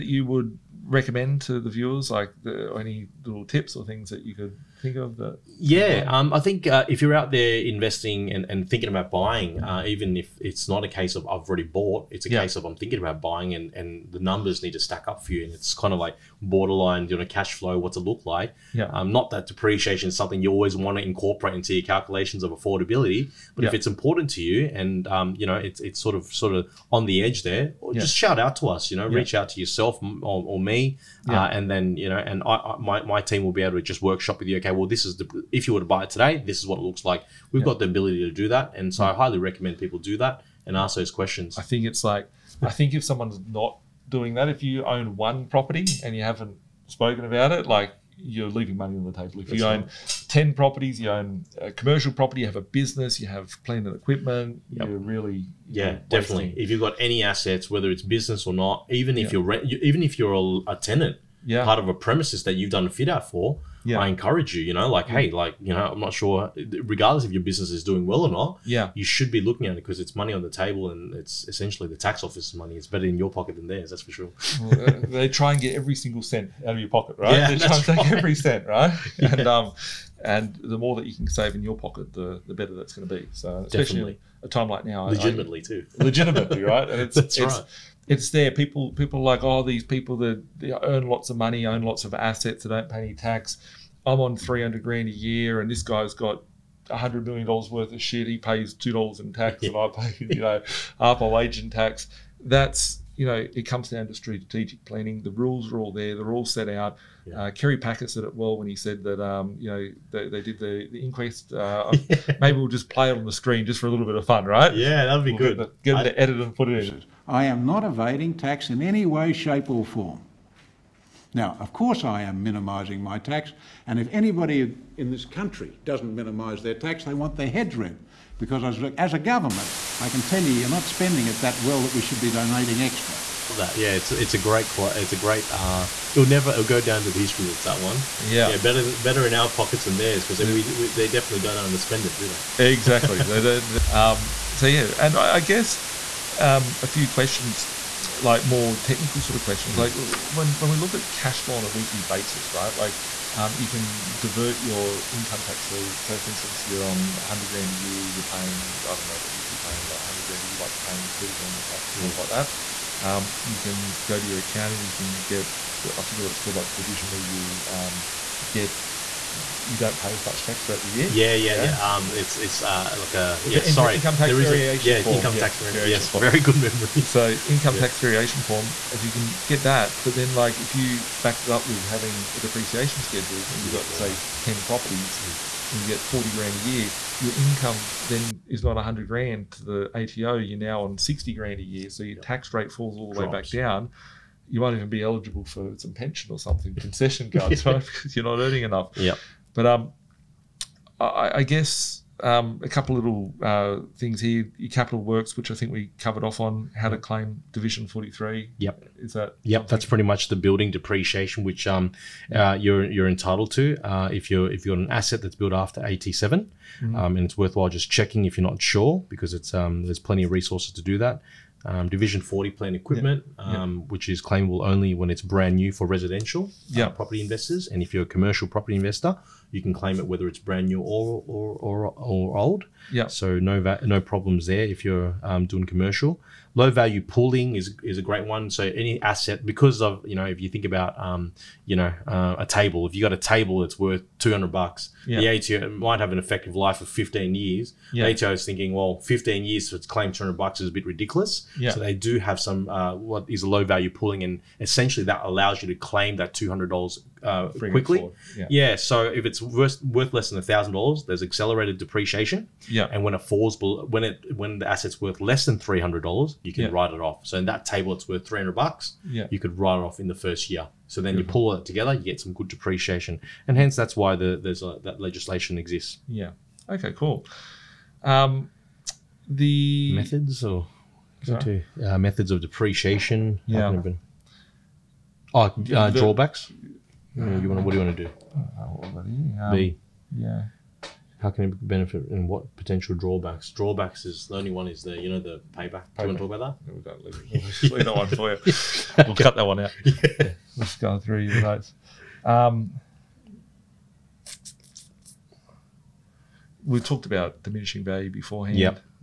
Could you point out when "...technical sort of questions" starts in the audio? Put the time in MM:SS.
02:28.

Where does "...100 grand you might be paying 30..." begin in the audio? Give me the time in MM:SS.
02:39.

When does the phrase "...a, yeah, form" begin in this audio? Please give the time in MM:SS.
02:54.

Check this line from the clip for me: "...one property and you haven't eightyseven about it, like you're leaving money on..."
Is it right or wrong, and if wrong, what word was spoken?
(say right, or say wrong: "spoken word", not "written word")
wrong: "spoken", not "eightyseven".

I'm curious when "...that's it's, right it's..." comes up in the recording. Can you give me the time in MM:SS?
01:27.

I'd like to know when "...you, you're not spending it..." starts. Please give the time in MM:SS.
02:10.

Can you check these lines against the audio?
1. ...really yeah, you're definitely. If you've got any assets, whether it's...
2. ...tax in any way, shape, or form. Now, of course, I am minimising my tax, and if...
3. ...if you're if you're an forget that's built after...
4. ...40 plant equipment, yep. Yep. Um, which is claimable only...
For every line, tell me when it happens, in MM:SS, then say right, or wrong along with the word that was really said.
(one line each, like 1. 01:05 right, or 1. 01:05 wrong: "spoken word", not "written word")
1. 00:54 right
2. 01:58 right
3. 03:34 wrong: "asset", not "forget"
4. 03:42 right.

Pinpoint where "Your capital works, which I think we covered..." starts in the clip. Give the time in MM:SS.
03:24.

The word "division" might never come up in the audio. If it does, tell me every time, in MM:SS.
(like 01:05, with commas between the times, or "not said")
02:46, 03:27, 03:41.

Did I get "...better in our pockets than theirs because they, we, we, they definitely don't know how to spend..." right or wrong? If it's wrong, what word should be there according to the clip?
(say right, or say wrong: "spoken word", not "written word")
right.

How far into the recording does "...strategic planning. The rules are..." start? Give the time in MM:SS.
01:44.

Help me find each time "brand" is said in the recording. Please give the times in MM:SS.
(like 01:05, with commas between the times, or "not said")
03:45, 03:50.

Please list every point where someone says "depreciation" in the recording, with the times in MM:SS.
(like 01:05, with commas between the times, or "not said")
00:19, 03:02, 03:30, 04:21, 04:32, 04:42.